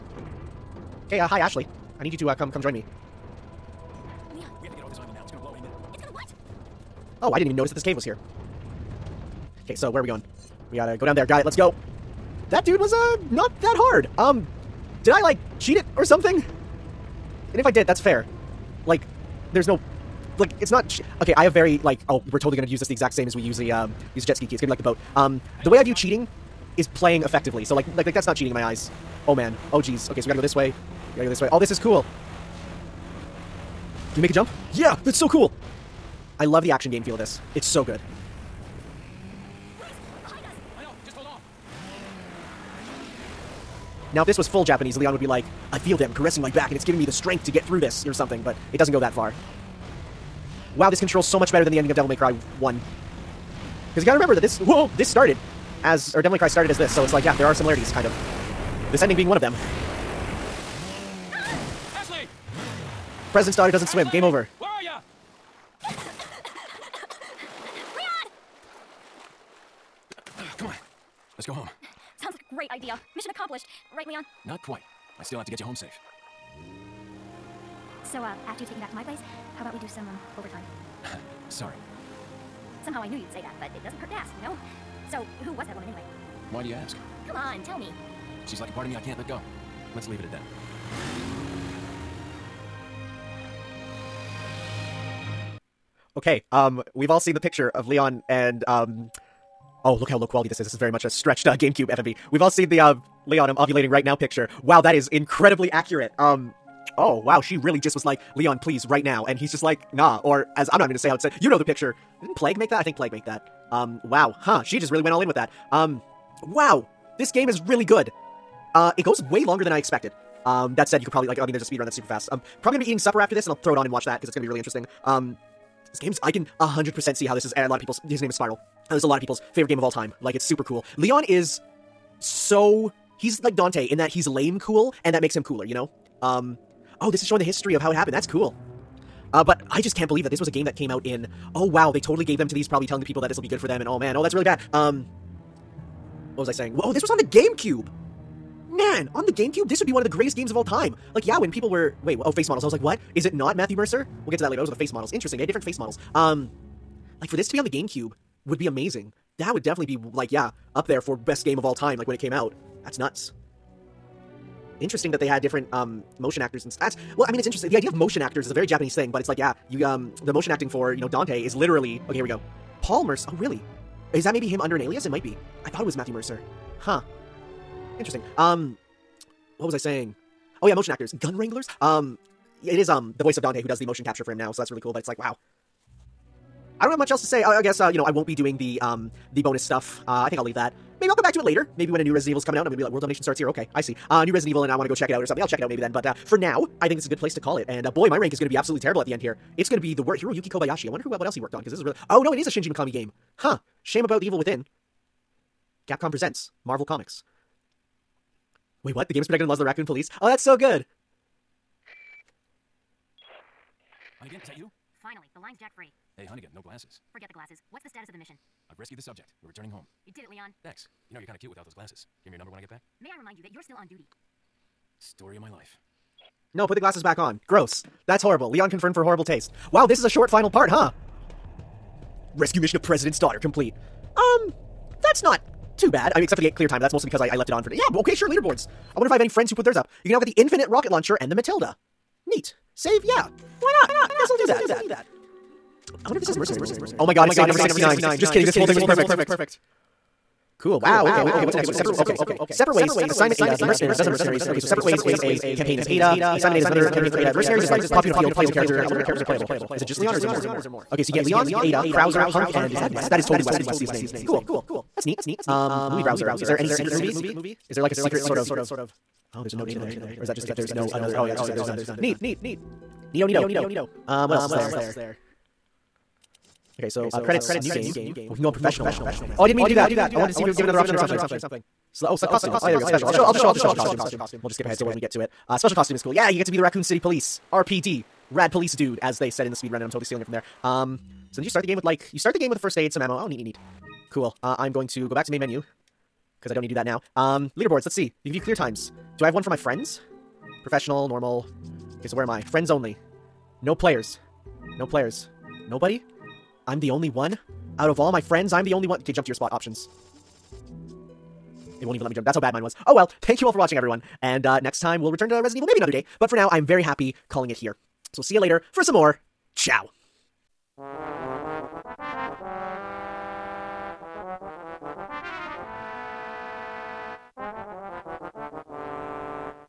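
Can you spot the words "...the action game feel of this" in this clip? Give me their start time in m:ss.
0:36.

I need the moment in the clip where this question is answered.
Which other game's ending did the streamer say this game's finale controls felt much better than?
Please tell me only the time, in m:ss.
0:51.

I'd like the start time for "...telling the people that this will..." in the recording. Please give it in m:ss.
2:22.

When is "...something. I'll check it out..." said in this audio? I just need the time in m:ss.
3:15.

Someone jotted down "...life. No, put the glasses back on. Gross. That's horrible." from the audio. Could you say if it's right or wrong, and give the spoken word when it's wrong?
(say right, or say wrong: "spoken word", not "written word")
right.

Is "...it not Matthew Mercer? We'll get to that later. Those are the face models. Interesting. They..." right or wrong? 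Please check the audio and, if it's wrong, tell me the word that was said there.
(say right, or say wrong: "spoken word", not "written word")
right.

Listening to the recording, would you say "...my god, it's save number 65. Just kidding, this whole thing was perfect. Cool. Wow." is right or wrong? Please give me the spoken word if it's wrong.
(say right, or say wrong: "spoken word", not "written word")
wrong: "69", not "65".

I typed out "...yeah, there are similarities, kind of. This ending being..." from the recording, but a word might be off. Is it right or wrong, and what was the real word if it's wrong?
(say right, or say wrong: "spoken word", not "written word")
right.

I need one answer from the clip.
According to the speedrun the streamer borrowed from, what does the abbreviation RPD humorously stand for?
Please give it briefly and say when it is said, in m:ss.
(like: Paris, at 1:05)
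Rad Police Dude, at 4:48.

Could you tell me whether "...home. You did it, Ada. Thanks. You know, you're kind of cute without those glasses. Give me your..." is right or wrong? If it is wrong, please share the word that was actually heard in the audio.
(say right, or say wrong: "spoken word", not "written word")
wrong: "Leon", not "Ada".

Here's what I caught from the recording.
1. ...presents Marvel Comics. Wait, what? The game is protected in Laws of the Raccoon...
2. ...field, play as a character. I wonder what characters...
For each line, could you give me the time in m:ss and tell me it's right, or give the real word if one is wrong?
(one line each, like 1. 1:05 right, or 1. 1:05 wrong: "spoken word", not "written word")
1. 3:26 right
2. 4:18 right.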